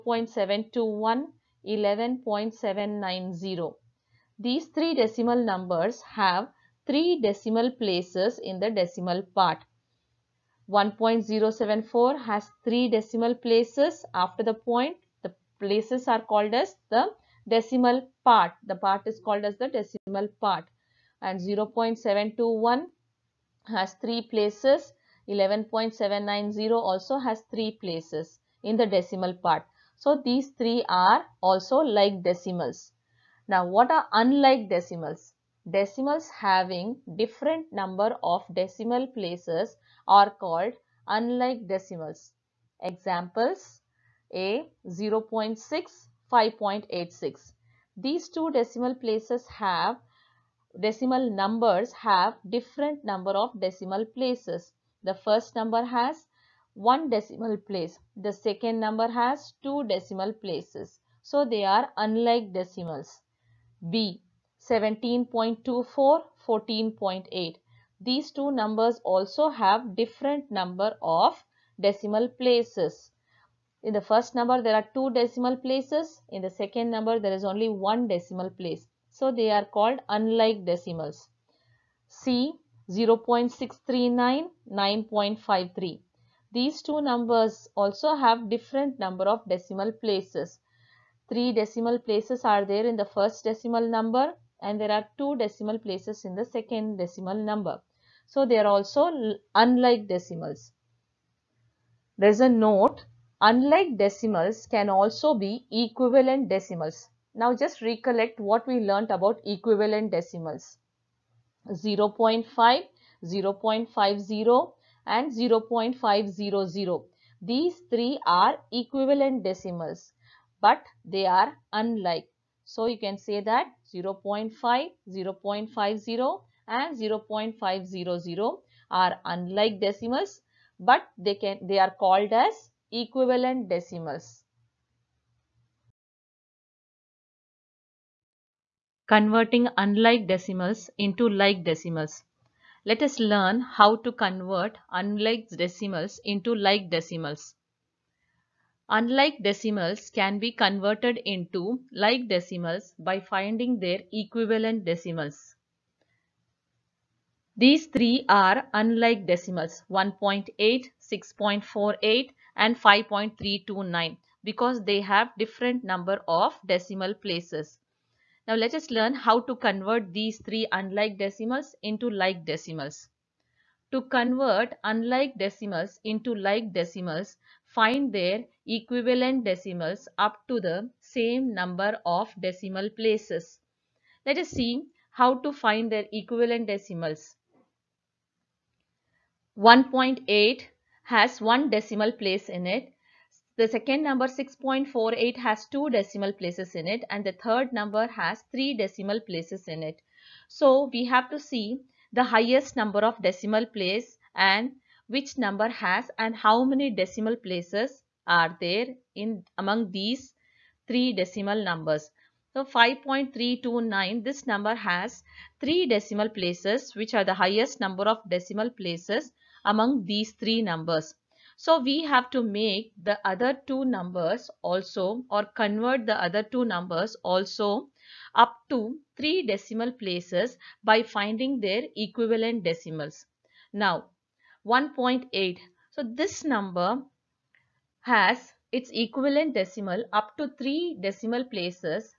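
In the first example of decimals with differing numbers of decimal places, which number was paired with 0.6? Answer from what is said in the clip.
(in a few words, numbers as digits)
5.86.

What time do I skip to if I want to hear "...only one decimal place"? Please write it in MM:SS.
01:17.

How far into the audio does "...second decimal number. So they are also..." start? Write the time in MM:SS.
01:36.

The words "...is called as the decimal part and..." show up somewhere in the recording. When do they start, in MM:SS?
00:19.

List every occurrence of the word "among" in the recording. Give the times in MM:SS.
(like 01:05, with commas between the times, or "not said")
03:29, 03:39.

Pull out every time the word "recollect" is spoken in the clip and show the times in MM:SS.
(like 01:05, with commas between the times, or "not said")
01:47.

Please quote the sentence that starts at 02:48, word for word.
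Now let us learn how to convert these three unlike decimals into like decimals.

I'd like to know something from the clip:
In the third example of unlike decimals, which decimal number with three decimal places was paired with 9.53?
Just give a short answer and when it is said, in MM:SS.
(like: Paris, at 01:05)
0.639, at 01:22.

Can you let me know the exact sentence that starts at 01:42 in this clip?
There is a note, unlike decimals can also be equivalent decimals.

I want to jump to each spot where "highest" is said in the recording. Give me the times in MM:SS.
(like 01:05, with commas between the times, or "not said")
03:22, 03:37.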